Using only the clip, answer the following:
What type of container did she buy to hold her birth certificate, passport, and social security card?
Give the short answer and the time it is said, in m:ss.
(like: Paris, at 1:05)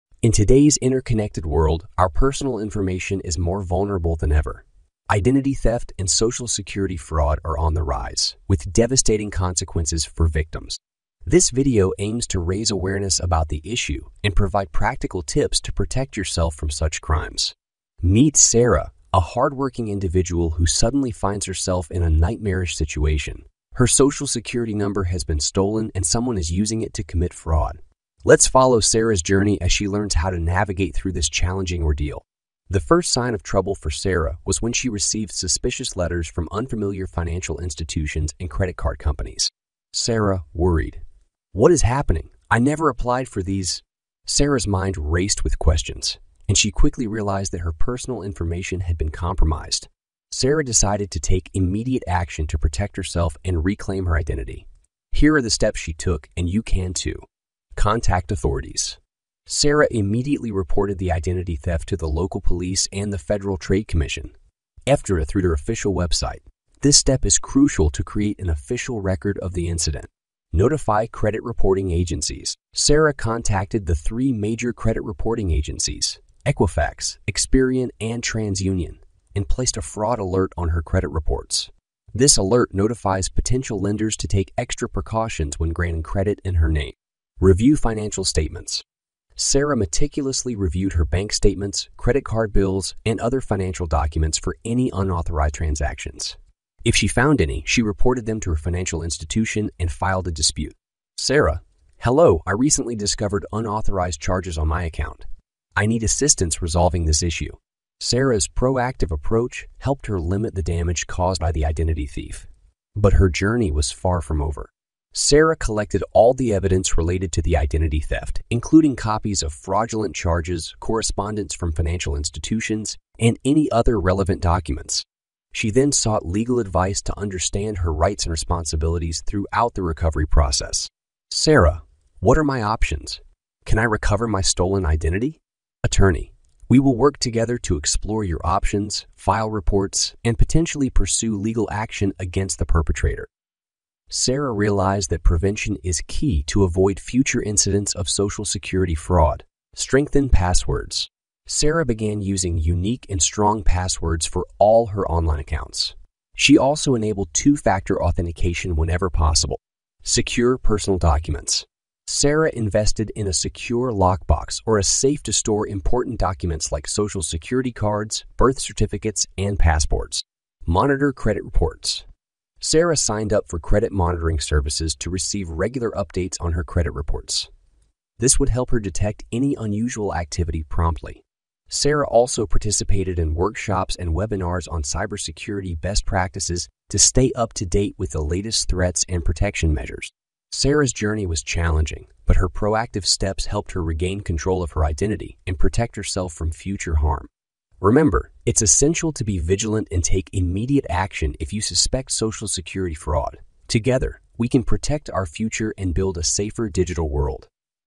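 secure lockbox, at 2:43.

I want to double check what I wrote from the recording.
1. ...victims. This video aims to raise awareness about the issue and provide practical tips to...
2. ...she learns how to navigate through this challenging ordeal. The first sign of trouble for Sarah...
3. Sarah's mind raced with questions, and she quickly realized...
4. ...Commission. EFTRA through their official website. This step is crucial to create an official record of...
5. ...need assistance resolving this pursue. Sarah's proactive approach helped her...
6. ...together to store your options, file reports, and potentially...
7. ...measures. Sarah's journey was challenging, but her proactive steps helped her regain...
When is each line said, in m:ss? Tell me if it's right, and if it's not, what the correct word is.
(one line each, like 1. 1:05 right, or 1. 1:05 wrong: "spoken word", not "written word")
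1. 0:10 right
2. 0:29 right
3. 0:44 right
4. 1:03 right
5. 1:45 wrong: "issue", not "pursue"
6. 2:17 wrong: "explore", not "store"
7. 3:09 right.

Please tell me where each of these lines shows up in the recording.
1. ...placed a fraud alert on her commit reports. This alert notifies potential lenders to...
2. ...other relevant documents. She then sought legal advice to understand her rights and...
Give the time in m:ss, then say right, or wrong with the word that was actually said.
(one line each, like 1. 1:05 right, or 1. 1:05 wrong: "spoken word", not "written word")
1. 1:19 wrong: "credit", not "commit"
2. 2:03 right.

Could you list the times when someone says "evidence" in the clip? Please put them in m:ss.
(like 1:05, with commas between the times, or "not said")
1:56.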